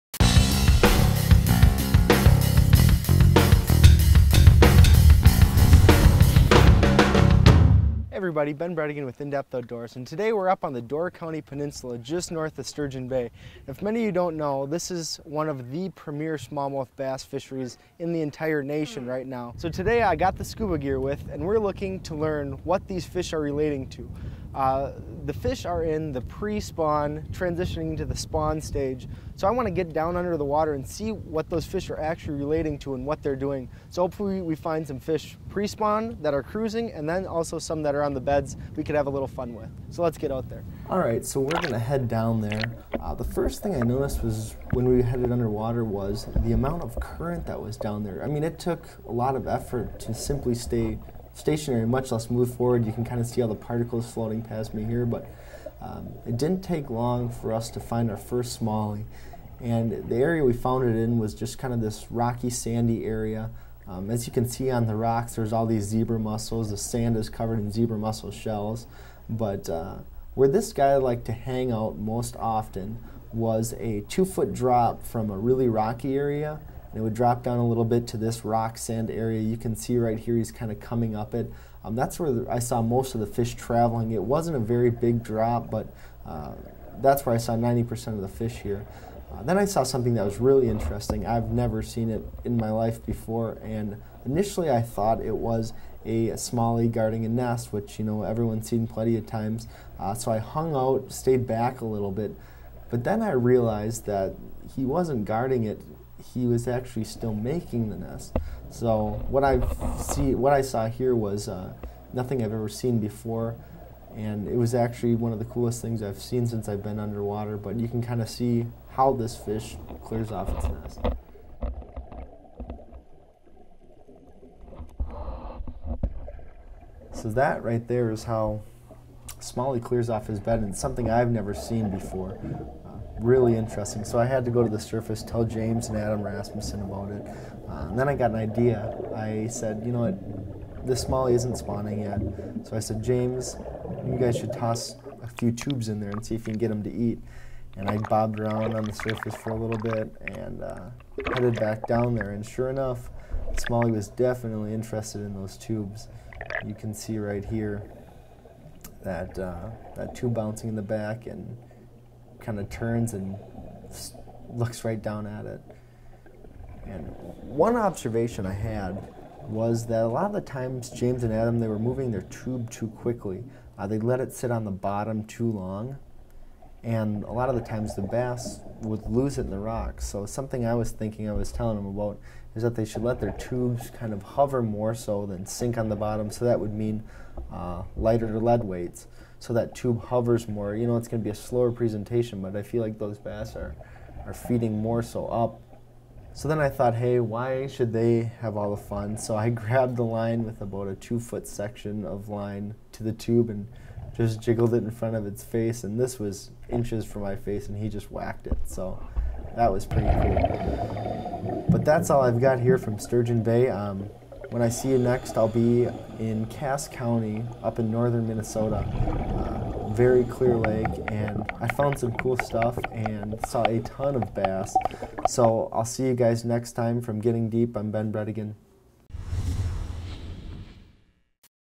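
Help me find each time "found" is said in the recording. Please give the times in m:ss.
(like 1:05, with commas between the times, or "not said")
1:00, 3:41.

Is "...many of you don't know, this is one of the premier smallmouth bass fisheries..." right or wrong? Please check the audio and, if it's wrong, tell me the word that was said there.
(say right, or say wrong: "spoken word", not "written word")
right.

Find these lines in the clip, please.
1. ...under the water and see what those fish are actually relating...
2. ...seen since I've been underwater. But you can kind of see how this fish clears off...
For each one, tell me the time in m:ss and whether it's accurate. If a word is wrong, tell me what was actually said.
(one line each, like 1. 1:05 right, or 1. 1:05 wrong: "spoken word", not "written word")
1. 0:30 right
2. 1:56 right.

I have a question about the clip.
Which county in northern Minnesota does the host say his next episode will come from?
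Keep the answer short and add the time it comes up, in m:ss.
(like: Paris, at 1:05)
Cass County, at 3:36.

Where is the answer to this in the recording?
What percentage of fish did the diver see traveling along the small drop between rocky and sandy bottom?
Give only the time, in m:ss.
1:27.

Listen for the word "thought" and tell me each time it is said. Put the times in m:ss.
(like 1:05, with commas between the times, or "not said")
1:34, 3:16.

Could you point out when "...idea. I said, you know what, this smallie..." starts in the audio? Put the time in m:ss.
2:18.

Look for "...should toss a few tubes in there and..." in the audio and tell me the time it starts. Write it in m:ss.
2:24.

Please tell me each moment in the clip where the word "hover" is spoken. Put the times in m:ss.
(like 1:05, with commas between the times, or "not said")
3:04, 3:10.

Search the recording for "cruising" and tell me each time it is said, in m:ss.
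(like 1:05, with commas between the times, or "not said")
0:36.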